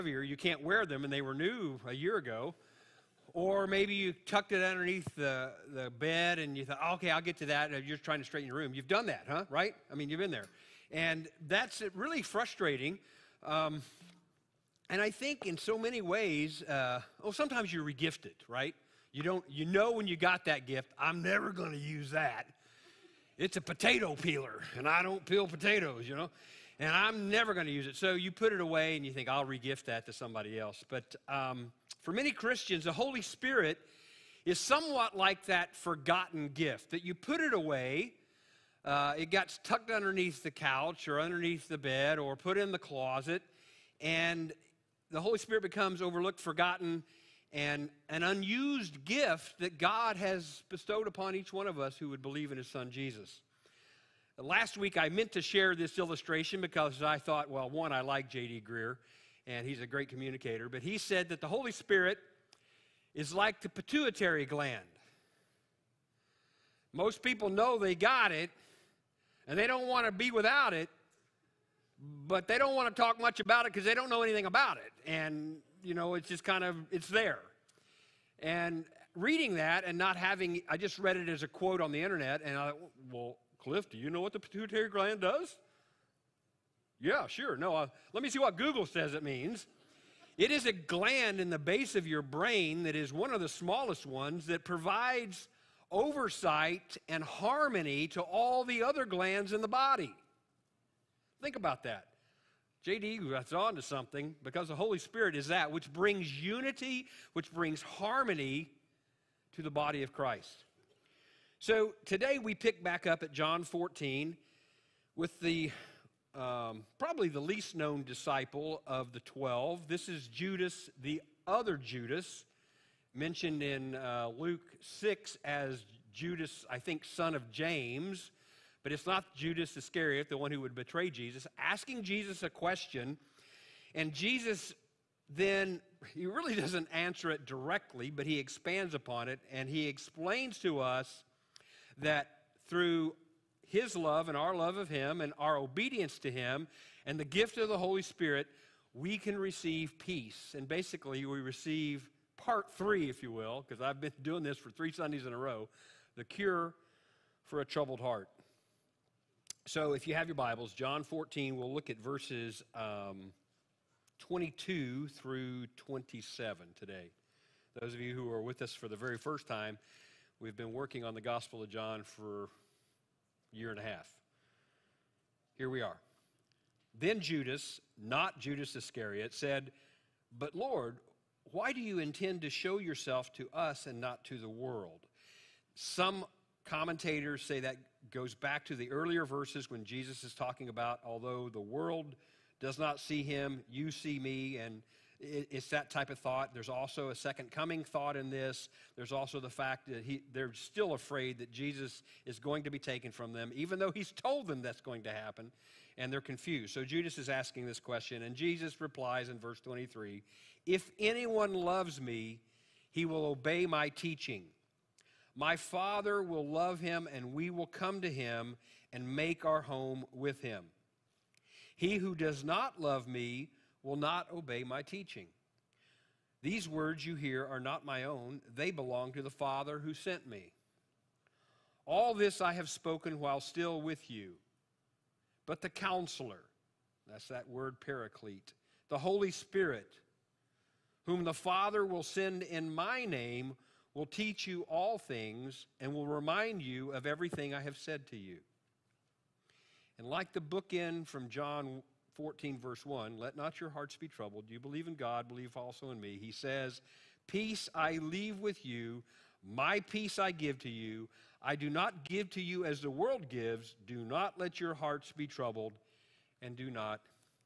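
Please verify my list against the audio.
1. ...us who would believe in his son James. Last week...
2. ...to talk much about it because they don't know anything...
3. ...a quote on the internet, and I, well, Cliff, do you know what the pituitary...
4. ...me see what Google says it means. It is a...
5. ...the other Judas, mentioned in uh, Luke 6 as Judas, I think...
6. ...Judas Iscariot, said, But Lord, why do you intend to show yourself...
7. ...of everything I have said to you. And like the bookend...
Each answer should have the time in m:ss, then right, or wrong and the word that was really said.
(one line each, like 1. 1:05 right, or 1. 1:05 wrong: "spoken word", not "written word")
1. 0:51 wrong: "Jesus", not "James"
2. 1:12 right
3. 1:21 right
4. 1:28 right
5. 2:01 right
6. 2:58 right
7. 4:06 right.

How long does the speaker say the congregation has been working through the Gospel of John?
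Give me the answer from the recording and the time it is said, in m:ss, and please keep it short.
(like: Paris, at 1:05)
a year and a half, at 2:52.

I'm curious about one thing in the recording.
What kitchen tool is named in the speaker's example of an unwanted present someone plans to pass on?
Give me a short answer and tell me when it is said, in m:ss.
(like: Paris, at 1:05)
potato peeler, at 0:23.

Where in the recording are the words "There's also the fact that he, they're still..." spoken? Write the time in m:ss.
3:18.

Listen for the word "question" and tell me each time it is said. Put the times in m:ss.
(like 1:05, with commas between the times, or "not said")
2:12, 3:27.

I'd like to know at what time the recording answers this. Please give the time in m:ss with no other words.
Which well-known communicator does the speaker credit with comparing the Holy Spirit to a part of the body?
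0:58.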